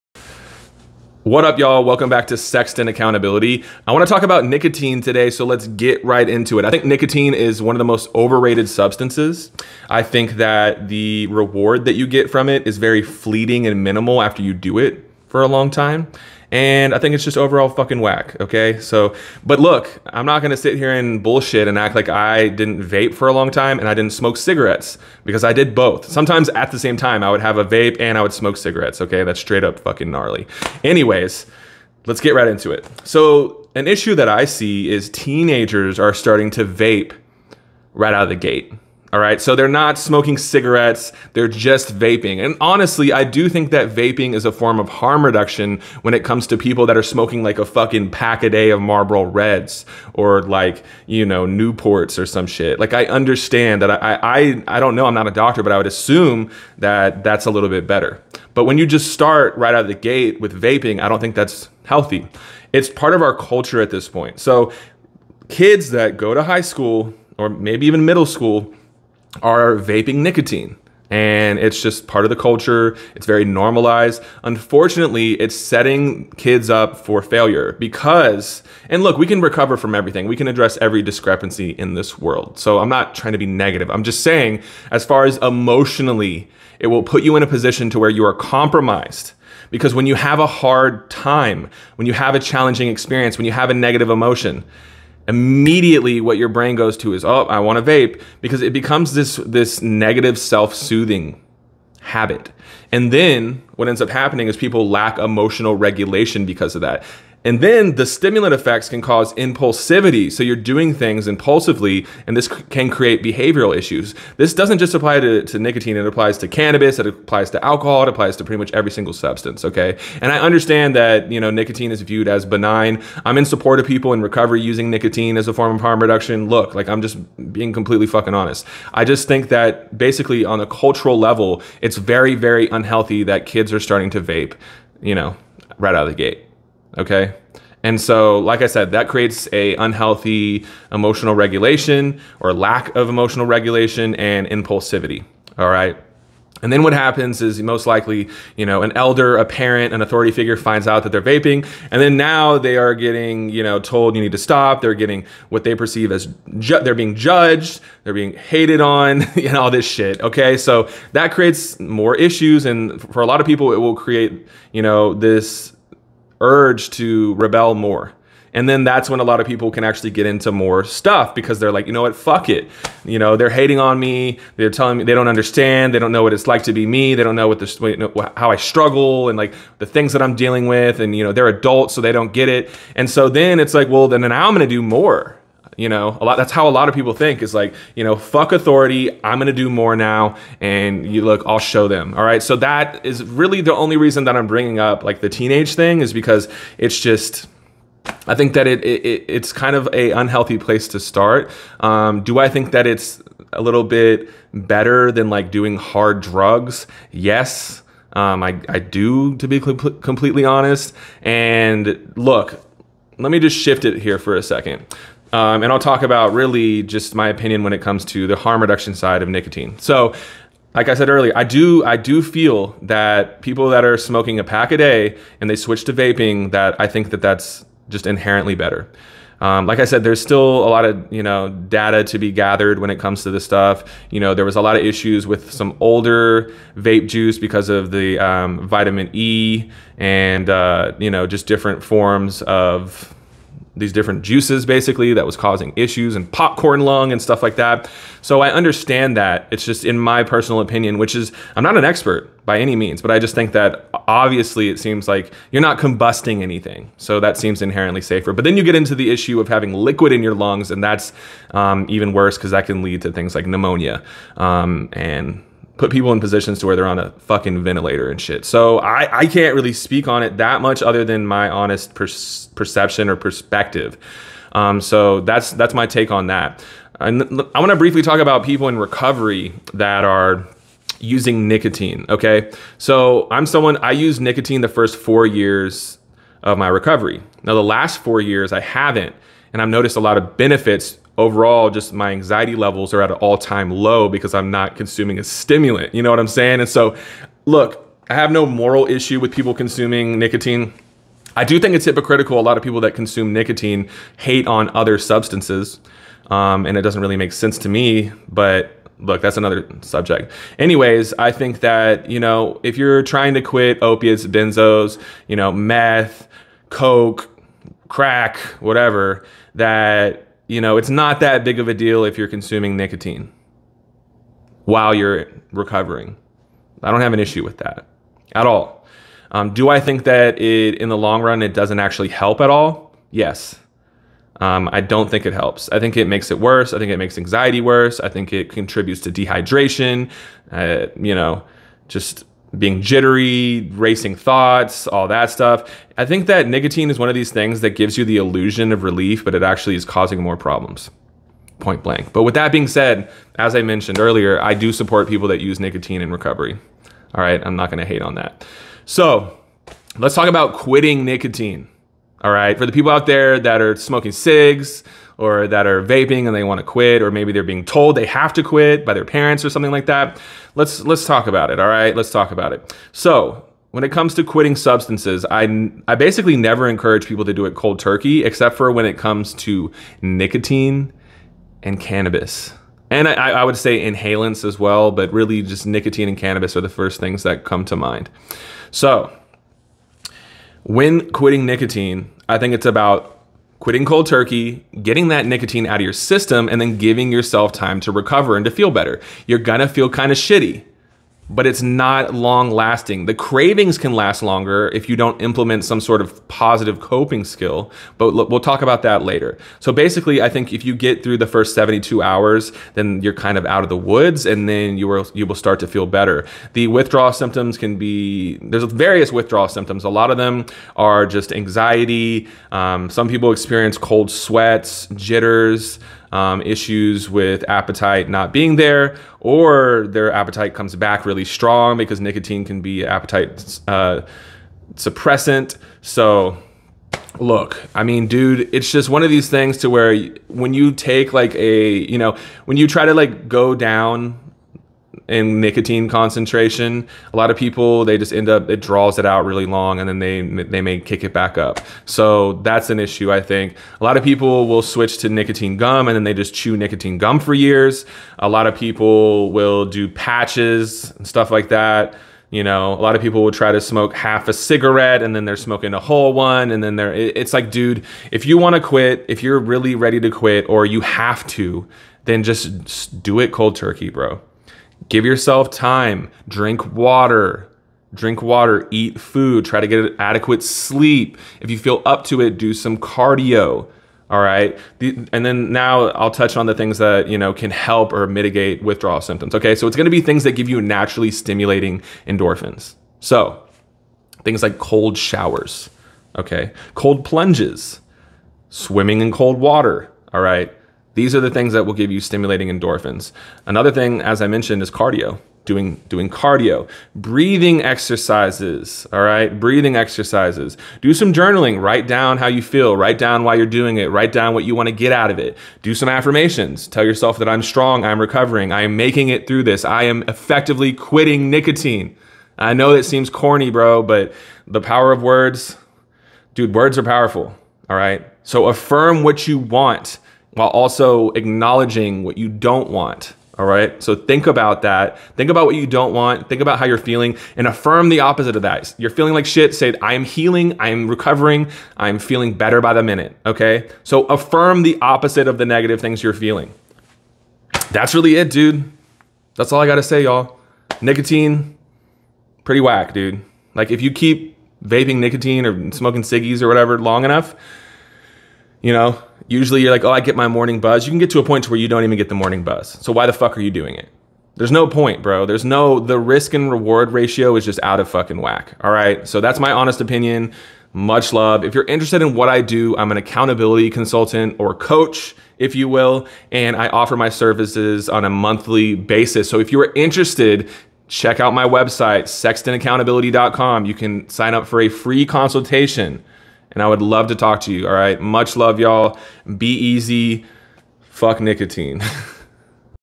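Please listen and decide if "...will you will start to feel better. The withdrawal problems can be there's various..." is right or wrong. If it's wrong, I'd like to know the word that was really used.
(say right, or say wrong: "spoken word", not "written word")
wrong: "symptoms", not "problems".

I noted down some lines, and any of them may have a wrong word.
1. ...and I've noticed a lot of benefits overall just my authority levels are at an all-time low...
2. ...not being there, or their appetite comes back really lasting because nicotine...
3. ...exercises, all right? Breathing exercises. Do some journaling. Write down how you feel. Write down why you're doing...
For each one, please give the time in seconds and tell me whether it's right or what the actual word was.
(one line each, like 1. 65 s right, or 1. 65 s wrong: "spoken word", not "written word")
1. 289 s wrong: "anxiety", not "authority"
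2. 428 s wrong: "strong", not "lasting"
3. 507 s right.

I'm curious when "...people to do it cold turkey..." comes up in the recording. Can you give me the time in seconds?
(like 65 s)
377 s.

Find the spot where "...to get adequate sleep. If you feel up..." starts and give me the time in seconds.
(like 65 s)
479 s.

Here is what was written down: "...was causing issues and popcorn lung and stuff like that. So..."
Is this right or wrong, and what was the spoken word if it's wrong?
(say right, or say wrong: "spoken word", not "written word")
right.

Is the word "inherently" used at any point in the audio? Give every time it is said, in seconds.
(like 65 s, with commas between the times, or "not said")
228 s, 257 s.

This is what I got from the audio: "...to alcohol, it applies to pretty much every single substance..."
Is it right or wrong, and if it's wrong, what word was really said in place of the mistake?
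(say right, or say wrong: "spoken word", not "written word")
right.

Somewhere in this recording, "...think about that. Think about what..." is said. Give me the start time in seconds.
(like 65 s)
533 s.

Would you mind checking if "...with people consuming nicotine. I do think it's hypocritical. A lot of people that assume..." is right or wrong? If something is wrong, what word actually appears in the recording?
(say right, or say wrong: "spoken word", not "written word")
wrong: "consume", not "assume".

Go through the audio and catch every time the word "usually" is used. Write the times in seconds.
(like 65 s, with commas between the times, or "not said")
559 s.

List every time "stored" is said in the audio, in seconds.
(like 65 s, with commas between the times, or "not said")
not said.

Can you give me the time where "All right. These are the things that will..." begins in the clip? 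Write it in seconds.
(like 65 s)
500 s.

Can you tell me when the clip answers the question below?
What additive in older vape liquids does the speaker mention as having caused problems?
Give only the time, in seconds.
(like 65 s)
238 s.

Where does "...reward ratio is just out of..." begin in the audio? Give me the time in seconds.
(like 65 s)
566 s.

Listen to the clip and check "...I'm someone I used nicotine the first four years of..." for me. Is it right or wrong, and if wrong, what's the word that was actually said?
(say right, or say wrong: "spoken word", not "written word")
right.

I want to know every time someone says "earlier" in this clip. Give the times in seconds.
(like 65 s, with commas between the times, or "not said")
221 s, 353 s.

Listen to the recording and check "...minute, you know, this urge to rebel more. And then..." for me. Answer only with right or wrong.
wrong.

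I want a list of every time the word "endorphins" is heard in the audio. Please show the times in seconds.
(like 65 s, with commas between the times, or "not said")
492 s, 502 s.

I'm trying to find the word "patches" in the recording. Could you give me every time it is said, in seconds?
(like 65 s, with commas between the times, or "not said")
459 s.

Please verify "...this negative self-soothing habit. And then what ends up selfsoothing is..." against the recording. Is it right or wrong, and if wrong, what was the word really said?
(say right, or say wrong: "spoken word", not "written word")
wrong: "happening", not "selfsoothing".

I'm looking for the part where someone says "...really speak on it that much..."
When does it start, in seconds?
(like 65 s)
269 s.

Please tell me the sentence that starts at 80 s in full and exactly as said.
We can address every discrepancy in this world.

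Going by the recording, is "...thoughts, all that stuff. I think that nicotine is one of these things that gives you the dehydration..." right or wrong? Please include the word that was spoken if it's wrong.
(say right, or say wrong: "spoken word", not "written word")
wrong: "illusion", not "dehydration".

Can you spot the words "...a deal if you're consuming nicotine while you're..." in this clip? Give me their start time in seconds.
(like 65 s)
321 s.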